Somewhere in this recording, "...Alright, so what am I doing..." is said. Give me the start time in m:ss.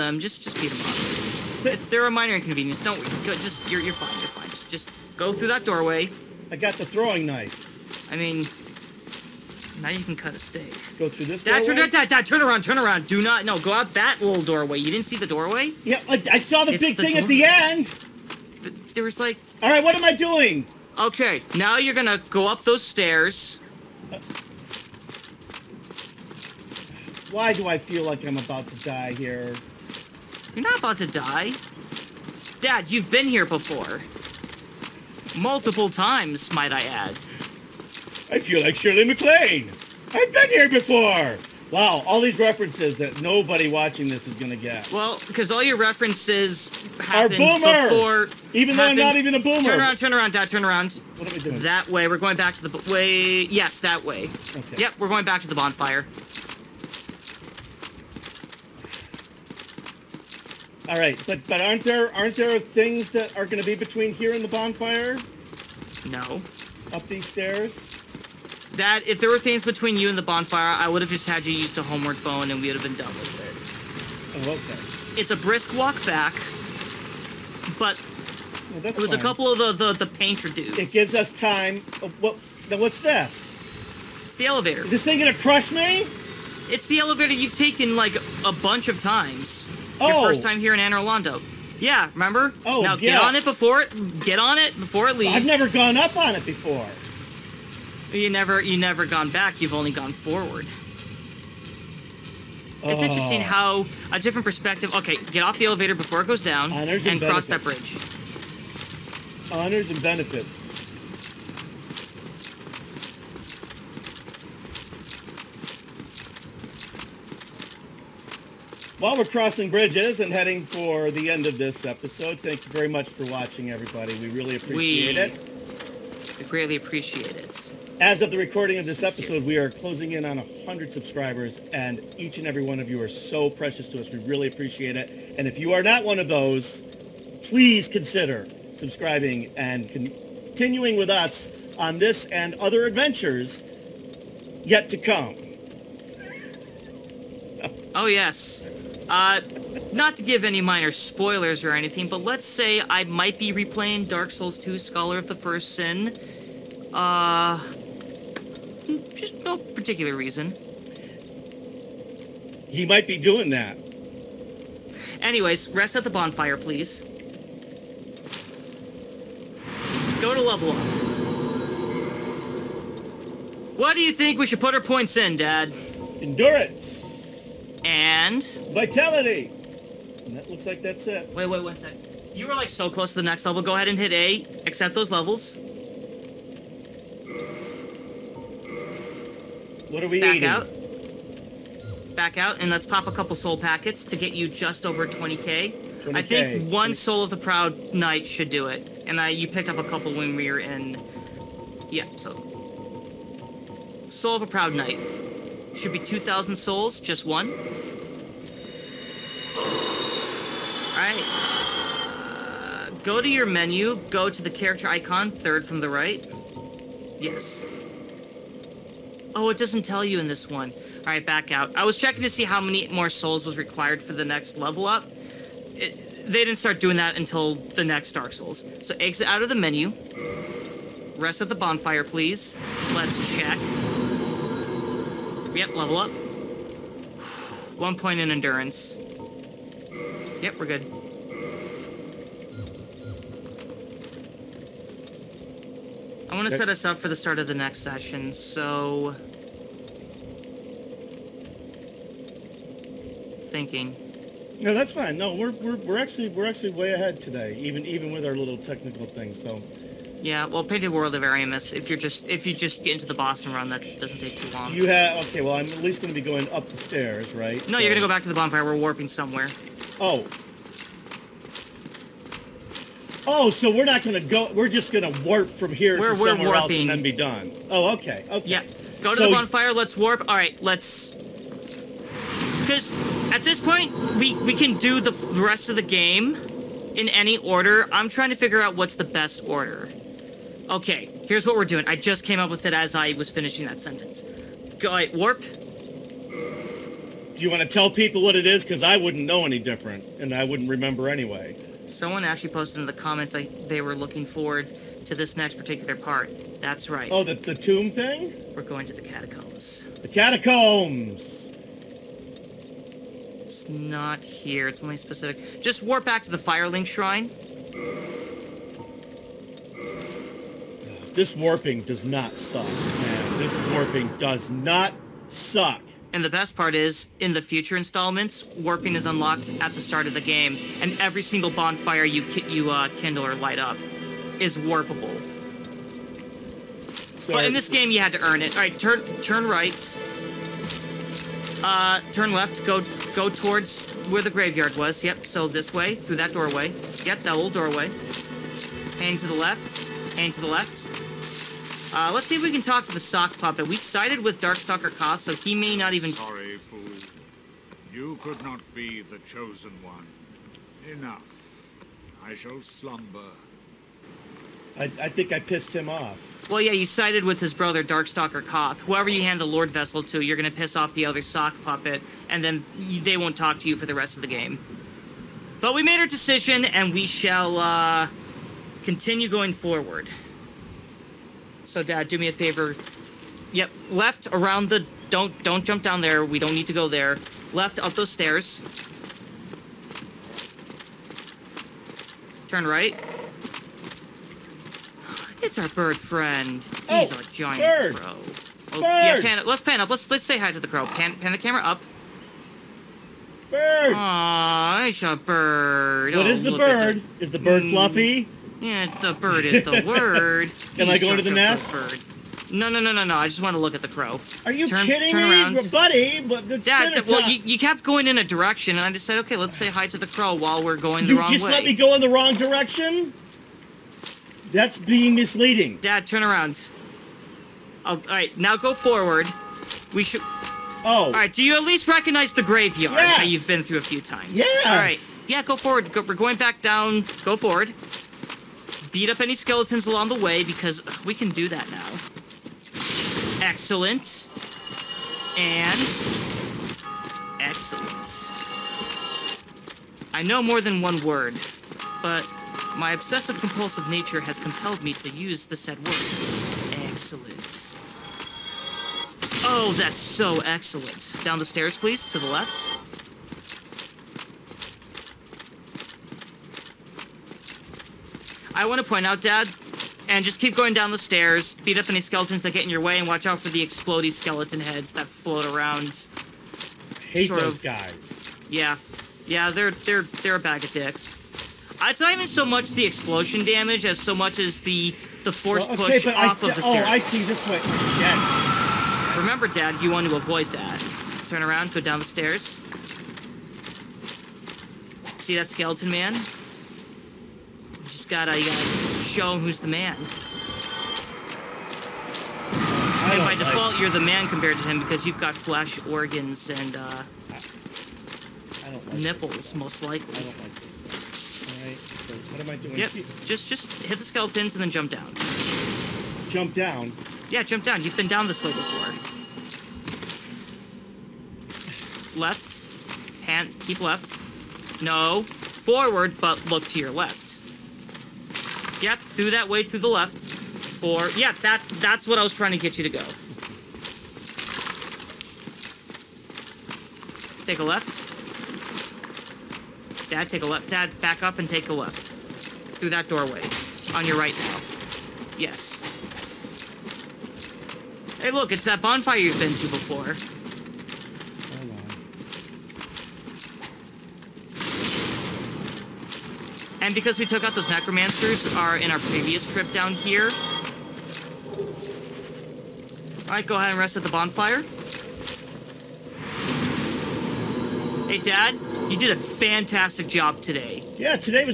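8:31.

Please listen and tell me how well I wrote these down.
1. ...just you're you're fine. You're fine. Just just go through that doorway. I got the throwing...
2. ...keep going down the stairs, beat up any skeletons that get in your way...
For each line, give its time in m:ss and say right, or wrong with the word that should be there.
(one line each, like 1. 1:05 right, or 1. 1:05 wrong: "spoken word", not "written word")
1. 0:03 right
2. 7:50 right.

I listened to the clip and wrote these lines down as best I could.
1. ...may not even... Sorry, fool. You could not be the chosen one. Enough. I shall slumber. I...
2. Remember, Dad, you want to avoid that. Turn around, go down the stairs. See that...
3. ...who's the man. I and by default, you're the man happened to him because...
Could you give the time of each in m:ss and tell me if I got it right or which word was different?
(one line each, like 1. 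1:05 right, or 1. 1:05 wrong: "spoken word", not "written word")
1. 5:55 right
2. 8:09 right
3. 8:19 wrong: "compared", not "happened".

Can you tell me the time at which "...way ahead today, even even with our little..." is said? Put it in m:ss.
4:16.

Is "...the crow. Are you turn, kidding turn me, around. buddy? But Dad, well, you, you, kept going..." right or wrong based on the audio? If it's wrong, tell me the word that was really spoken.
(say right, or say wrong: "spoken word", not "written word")
right.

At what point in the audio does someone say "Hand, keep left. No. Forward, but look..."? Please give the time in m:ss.
8:43.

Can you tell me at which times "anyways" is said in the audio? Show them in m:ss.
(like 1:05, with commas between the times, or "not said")
2:45, 5:01.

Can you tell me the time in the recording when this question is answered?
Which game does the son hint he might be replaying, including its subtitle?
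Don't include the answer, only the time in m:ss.
2:34.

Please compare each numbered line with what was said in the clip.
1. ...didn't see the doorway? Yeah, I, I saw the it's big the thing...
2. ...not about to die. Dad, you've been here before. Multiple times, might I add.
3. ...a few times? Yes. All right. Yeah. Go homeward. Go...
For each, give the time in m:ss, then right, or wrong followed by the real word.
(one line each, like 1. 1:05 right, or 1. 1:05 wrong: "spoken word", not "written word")
1. 0:14 right
2. 0:30 right
3. 7:13 wrong: "forward", not "homeward".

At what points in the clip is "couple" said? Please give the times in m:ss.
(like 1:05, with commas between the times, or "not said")
1:19, 3:13, 3:19.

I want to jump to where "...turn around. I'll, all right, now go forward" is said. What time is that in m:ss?
7:06.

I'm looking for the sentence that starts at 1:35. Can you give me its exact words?
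I've never gone up on it before.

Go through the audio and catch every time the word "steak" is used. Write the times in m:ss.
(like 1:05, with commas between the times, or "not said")
0:10.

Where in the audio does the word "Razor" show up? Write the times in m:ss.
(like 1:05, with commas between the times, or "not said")
not said.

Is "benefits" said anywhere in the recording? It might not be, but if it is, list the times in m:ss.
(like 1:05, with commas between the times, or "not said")
1:50.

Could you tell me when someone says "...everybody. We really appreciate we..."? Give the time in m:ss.
2:03.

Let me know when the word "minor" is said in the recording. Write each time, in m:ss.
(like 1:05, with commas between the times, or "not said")
0:02, 2:30.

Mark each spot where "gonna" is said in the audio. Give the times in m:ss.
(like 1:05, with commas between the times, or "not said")
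0:44, 1:25.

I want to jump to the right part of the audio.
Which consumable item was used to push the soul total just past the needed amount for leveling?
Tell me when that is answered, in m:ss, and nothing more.
3:16.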